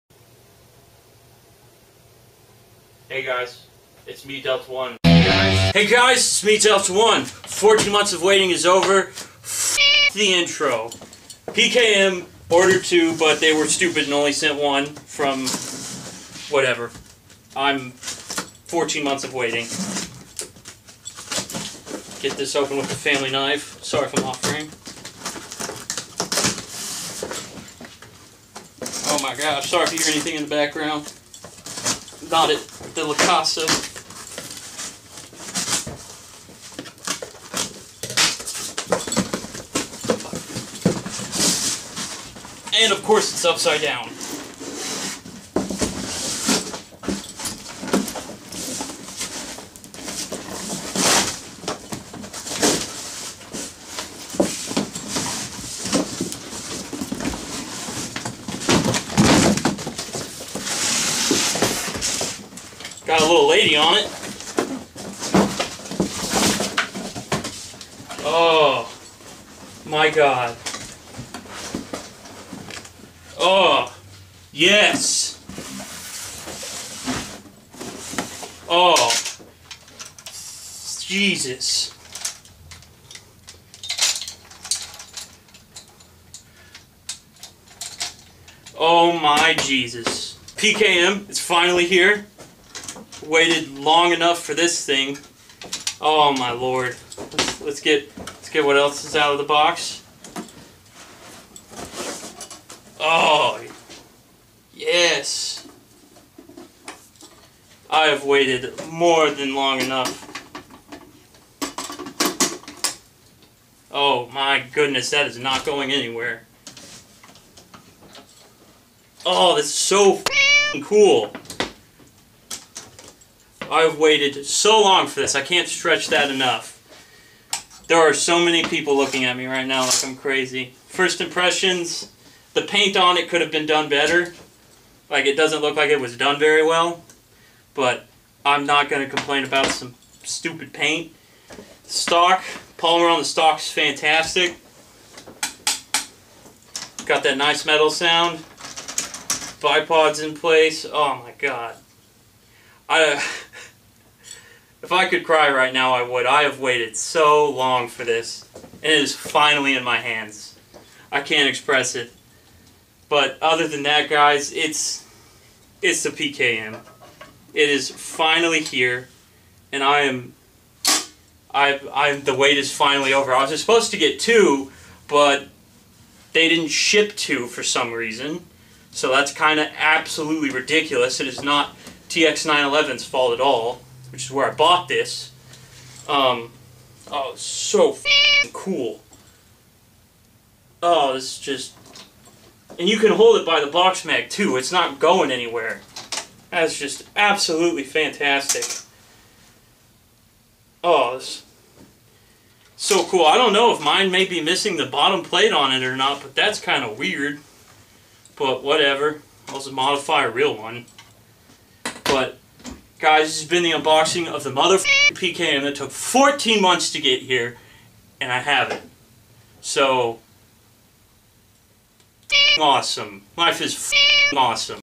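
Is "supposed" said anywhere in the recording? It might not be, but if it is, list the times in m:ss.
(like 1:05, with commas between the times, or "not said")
2:53.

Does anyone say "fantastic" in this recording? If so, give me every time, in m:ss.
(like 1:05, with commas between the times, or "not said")
2:23, 3:17.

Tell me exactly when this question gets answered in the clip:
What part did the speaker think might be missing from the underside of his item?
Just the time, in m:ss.
3:24.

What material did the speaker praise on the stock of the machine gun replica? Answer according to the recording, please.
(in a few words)
polymer.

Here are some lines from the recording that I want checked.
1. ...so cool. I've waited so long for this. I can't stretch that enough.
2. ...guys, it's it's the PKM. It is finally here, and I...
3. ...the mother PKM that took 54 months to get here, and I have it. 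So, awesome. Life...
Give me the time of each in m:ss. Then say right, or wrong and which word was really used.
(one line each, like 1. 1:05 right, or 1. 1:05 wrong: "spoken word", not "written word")
1. 1:59 right
2. 2:44 right
3. 3:34 wrong: "14", not "54".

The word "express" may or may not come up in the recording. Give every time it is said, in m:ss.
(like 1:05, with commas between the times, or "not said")
2:41.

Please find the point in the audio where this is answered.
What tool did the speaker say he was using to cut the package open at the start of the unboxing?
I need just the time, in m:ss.
0:22.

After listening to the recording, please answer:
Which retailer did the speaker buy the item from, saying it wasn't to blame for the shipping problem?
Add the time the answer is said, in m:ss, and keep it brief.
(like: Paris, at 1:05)
TX911, at 3:02.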